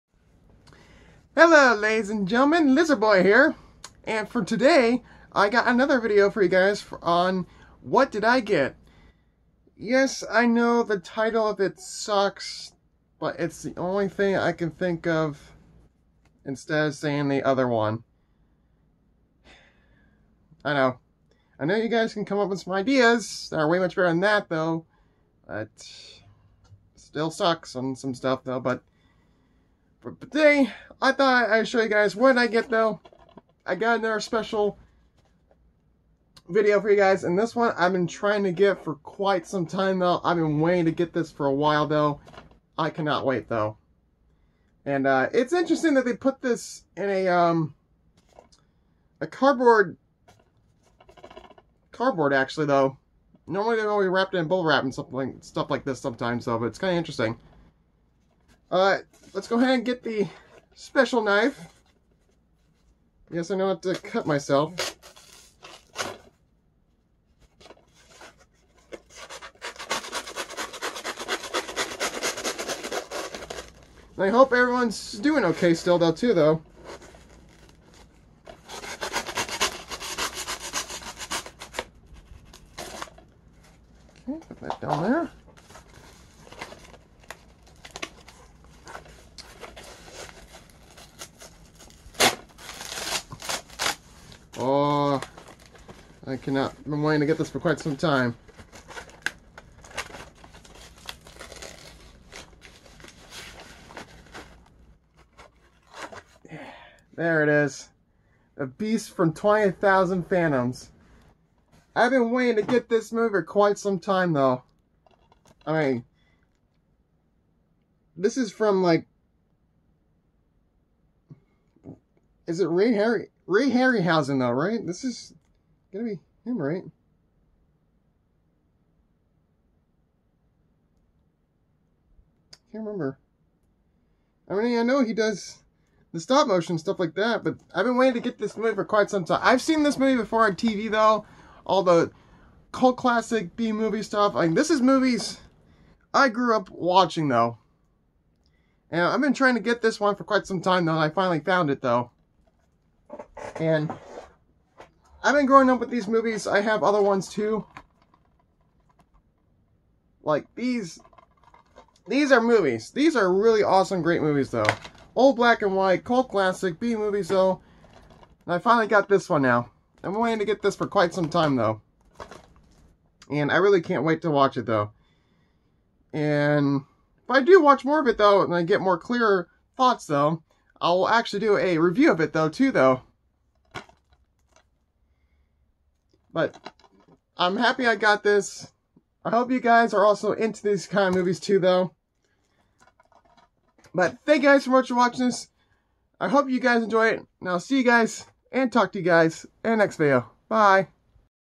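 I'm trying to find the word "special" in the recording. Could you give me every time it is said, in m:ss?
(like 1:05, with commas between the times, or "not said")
0:34, 1:00.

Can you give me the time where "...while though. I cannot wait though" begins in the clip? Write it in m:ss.
0:41.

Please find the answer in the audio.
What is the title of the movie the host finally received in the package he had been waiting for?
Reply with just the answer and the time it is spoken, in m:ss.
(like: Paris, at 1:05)
The Beast from 20,000 Fathoms, at 1:48.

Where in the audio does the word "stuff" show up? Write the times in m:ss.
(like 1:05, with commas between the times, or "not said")
0:28, 0:55, 2:16, 2:24.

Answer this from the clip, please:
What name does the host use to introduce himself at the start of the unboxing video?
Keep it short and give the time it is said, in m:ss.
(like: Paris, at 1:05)
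Lizardboy, at 0:02.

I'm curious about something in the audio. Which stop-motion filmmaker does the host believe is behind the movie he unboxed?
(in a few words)
Ray Harryhausen.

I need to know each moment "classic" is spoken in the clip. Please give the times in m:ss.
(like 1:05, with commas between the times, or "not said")
2:22, 2:46.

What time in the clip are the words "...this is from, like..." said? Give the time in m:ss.
1:58.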